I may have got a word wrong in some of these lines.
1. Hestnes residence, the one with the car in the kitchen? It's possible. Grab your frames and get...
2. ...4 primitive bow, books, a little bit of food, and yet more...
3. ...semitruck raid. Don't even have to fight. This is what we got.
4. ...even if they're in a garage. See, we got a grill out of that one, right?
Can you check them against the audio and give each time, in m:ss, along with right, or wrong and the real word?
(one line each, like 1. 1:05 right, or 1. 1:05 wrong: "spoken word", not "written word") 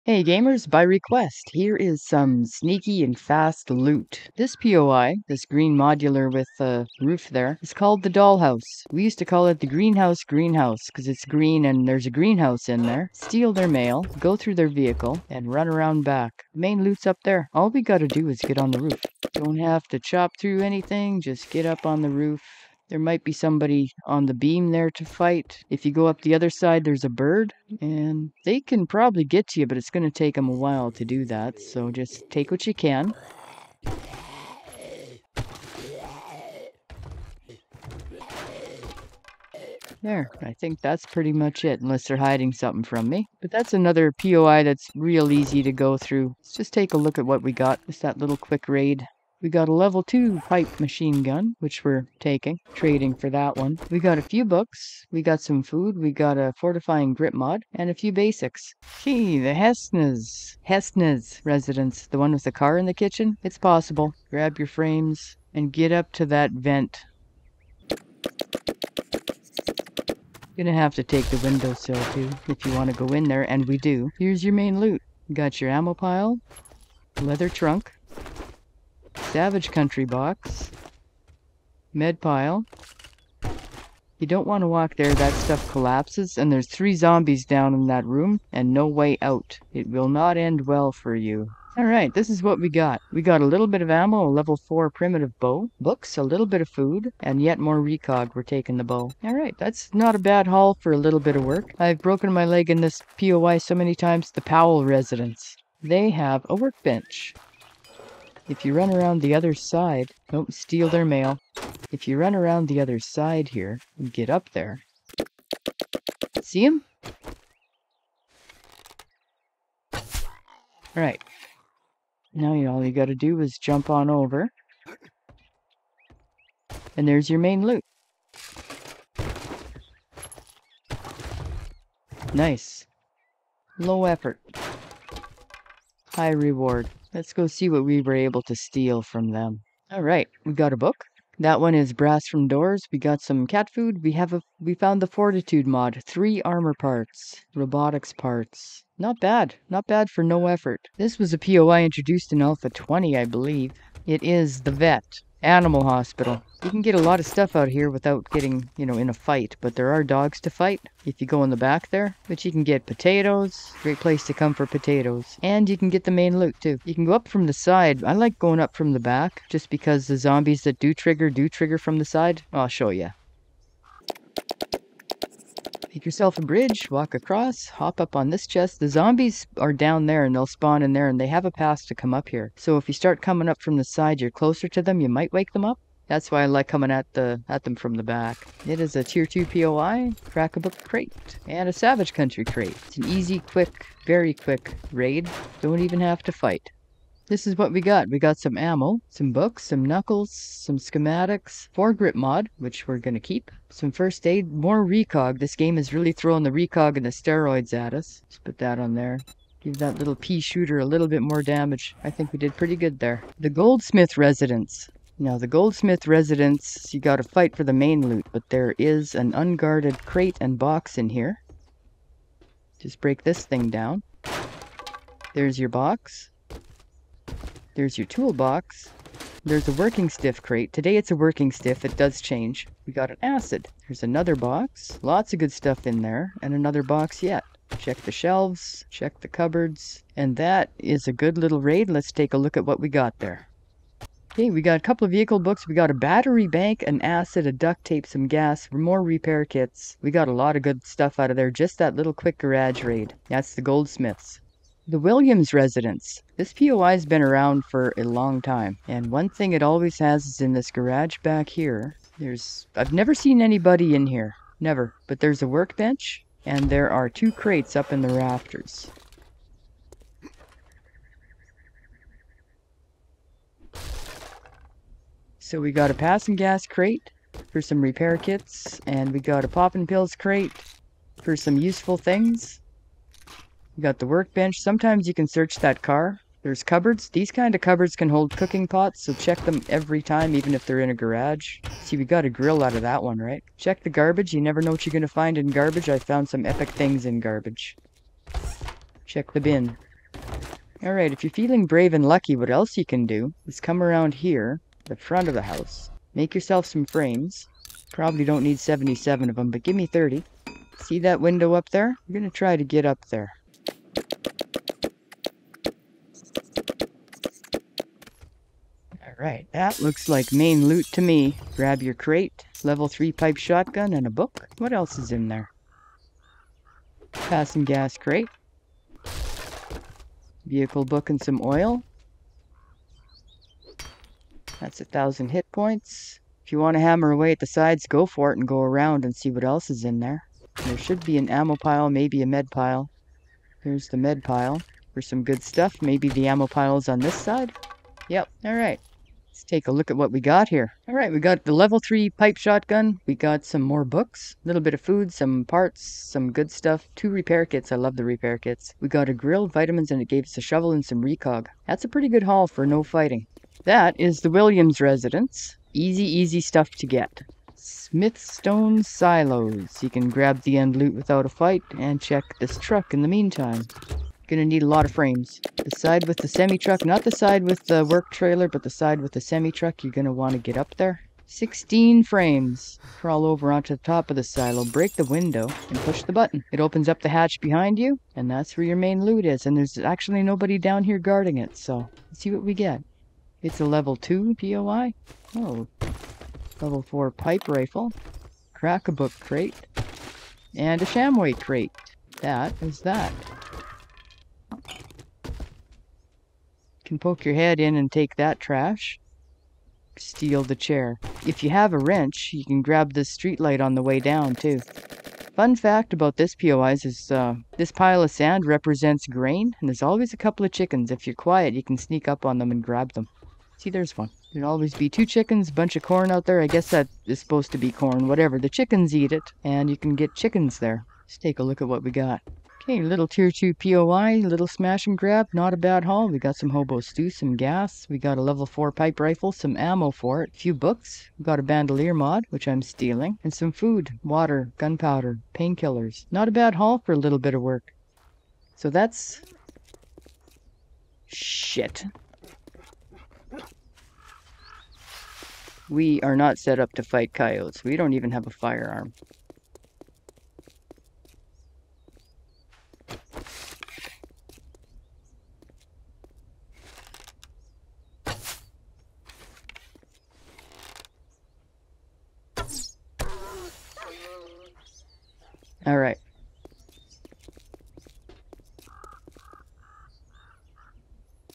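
1. 1:00 right
2. 1:34 right
3. 3:14 wrong: "quick", not "semitruck"
4. 4:50 right.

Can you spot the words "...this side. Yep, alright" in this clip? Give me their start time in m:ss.
5:46.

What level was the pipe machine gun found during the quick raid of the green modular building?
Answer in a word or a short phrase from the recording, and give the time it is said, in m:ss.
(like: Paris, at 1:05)
2, at 0:49.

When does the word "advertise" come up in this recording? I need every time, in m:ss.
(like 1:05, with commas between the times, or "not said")
not said.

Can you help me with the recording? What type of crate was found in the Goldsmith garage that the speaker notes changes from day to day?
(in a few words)
Working stiff crate.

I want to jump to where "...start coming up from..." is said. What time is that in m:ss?
3:02.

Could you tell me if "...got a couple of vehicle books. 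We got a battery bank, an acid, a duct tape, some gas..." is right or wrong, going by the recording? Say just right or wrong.
right.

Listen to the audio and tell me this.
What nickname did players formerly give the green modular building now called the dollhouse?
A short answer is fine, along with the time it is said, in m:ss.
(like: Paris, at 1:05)
The greenhouse greenhouse, at 0:09.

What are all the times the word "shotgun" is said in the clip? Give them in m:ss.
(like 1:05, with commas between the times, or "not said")
5:23, 5:52.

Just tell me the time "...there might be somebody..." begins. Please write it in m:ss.
0:22.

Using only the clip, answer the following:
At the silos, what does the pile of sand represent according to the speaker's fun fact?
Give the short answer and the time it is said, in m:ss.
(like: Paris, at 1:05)
Grain, at 6:57.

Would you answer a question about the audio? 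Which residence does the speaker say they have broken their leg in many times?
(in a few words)
Powell residence.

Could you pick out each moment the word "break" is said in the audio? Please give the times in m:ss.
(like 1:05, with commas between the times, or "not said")
3:43, 6:24.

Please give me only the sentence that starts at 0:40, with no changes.
There, I think that's pretty much it, unless they're hiding something from me.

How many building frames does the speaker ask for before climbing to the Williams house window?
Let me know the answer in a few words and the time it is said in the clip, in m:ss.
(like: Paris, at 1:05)
30, at 5:09.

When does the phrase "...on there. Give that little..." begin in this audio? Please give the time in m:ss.
3:28.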